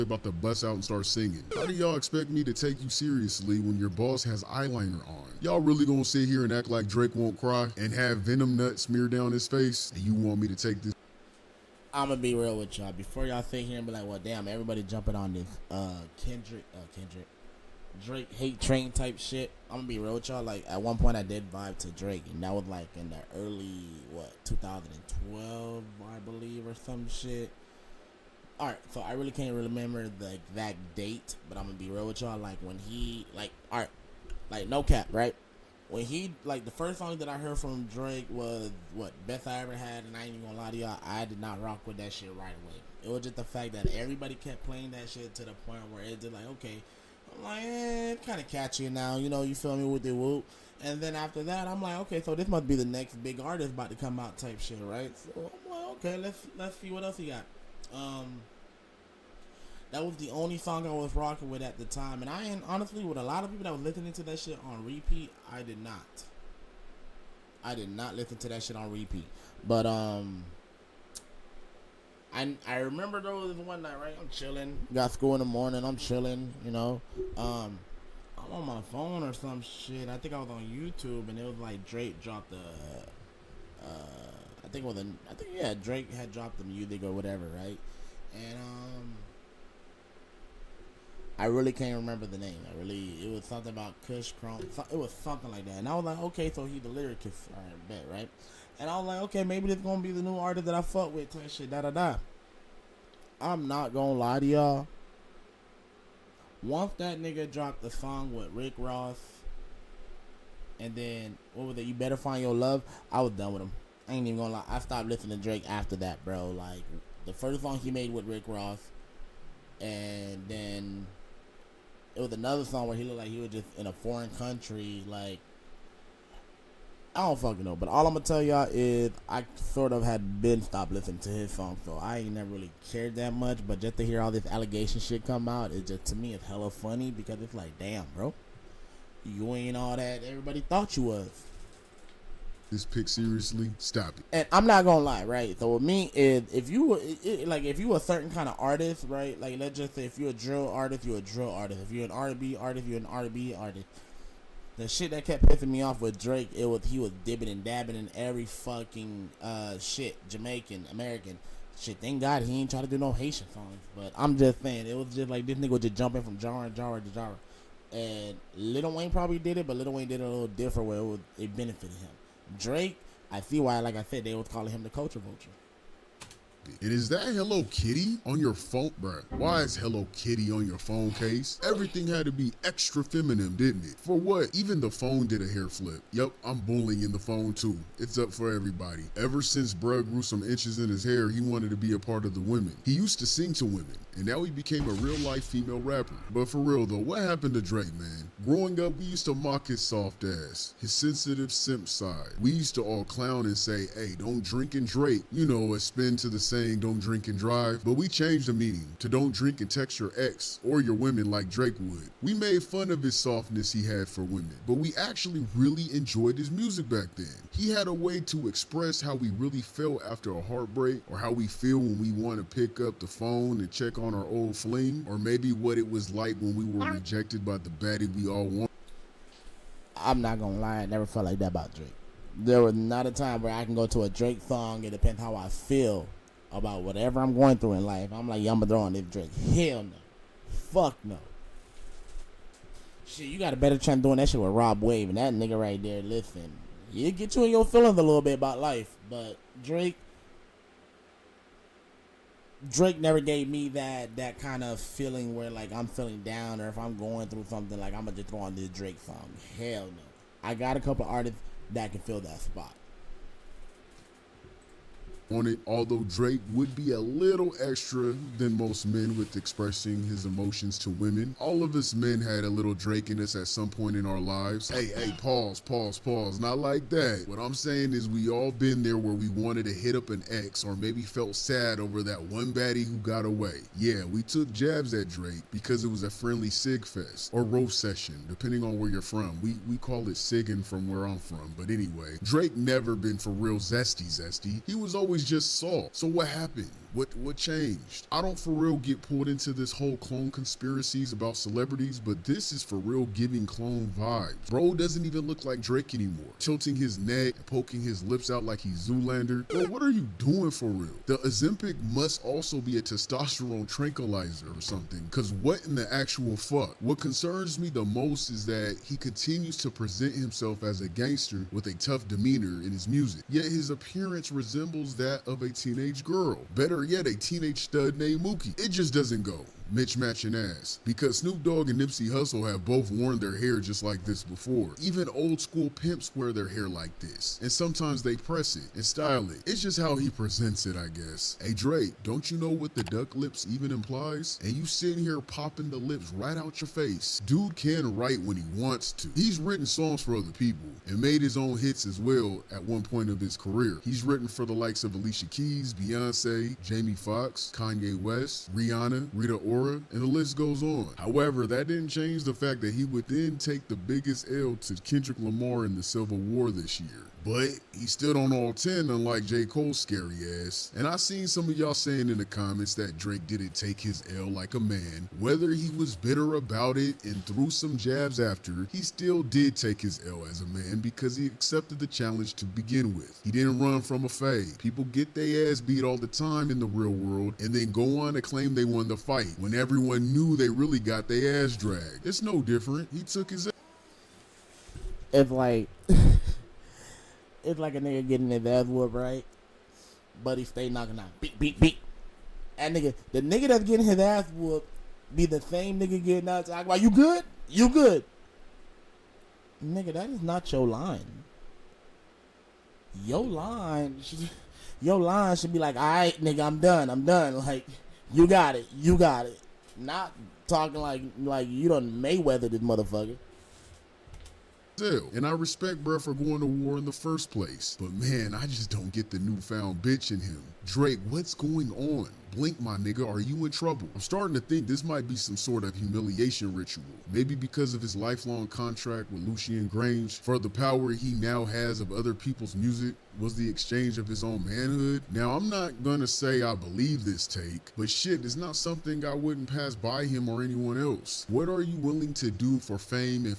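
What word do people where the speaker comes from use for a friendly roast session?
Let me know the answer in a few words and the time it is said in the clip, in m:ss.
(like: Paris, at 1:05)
sigging, at 4:50.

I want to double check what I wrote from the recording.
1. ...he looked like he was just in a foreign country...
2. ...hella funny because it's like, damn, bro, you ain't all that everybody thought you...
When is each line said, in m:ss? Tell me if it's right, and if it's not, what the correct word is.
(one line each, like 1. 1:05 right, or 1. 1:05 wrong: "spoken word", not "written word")
1. 2:02 right
2. 2:16 right.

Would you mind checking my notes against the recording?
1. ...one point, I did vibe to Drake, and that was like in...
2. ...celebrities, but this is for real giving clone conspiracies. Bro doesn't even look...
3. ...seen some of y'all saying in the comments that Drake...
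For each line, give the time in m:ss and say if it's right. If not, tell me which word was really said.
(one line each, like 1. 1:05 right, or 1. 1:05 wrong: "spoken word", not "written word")
1. 0:20 right
2. 5:01 wrong: "vibes", not "conspiracies"
3. 6:10 right.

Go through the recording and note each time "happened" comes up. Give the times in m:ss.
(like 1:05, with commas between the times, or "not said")
3:17, 4:56.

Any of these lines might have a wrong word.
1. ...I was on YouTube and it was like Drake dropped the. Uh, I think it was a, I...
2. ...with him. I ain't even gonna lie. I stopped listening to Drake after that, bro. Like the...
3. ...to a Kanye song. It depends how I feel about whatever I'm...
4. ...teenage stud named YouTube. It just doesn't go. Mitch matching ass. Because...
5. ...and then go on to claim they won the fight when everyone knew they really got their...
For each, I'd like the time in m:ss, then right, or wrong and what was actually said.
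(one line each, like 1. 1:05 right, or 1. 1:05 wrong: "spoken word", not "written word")
1. 1:20 right
2. 1:53 right
3. 3:53 wrong: "Drake", not "Kanye"
4. 5:27 wrong: "Mookie", not "YouTube"
5. 6:27 right.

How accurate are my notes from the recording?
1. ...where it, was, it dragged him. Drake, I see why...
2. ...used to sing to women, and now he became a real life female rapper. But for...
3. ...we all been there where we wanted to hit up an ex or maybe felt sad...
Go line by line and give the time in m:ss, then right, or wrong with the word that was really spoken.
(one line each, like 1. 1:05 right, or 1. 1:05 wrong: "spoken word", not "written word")
1. 2:50 wrong: "benefited", not "dragged"
2. 3:12 right
3. 4:38 right.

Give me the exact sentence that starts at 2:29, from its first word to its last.
Like, let's just say if you're a drill artist, you're a drill artist.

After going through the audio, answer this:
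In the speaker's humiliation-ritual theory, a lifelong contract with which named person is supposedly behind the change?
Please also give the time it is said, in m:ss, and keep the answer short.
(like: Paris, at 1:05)
Lucian Grainge, at 7:19.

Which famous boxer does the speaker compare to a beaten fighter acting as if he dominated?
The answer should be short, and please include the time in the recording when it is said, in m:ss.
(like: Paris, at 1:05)
Mayweather, at 7:01.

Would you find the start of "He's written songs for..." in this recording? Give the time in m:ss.
5:49.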